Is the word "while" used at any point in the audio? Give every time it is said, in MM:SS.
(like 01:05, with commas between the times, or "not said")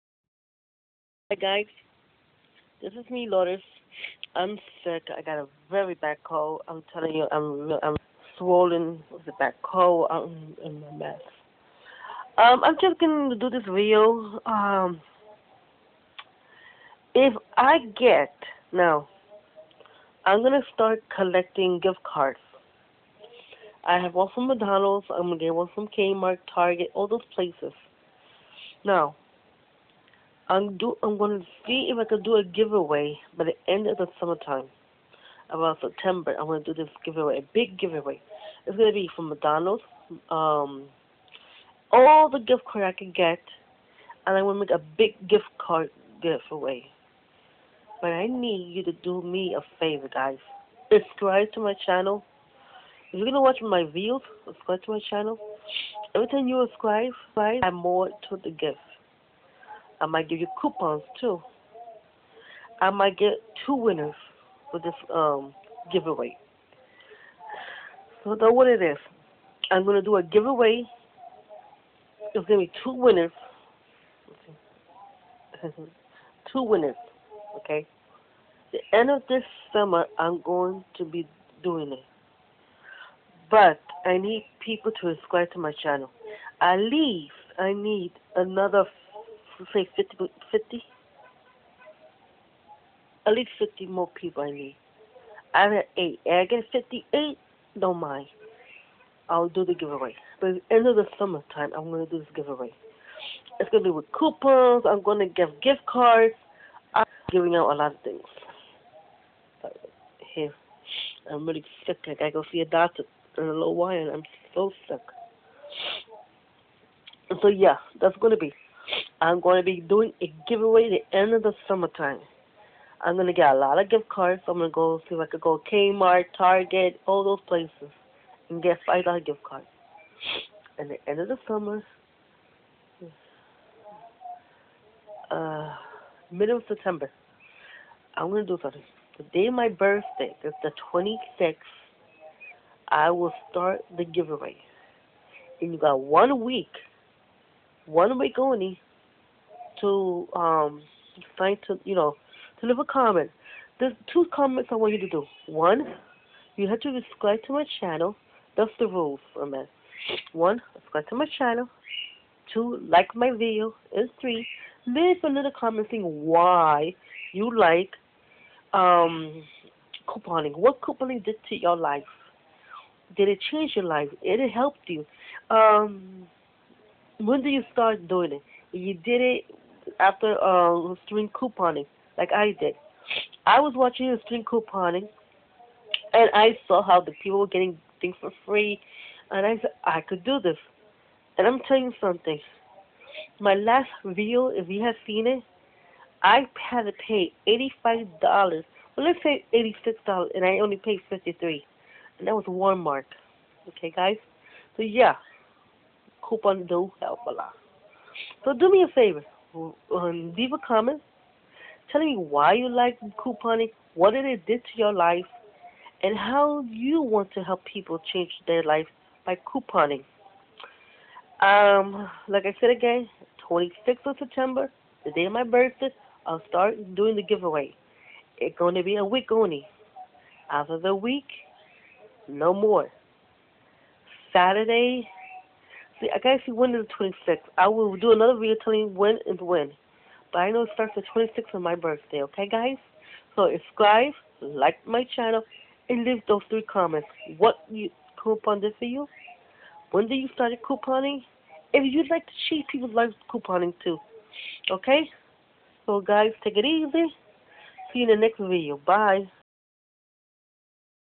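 01:53.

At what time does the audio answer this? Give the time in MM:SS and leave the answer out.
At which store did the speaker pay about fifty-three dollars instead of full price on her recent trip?
03:22.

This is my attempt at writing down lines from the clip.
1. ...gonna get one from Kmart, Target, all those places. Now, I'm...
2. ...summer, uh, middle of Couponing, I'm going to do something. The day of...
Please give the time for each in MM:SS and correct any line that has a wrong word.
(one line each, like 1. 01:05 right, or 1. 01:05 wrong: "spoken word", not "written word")
1. 00:25 right
2. 02:11 wrong: "September", not "Couponing".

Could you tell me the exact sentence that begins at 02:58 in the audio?
You did it after uh, Extreme Couponing, like I did.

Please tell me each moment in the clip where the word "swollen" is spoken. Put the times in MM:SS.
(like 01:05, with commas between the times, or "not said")
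00:08.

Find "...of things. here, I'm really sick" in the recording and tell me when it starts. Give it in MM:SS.
01:47.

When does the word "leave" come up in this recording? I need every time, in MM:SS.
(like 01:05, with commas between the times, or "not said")
02:32, 02:44, 03:30, 04:06.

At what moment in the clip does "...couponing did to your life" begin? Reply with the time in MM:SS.
02:50.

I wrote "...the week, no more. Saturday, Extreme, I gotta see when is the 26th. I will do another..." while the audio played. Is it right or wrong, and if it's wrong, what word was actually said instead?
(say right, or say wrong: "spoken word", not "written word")
wrong: "See", not "Extreme".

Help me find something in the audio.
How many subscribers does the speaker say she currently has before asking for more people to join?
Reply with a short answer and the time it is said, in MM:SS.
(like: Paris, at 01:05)
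8, at 01:35.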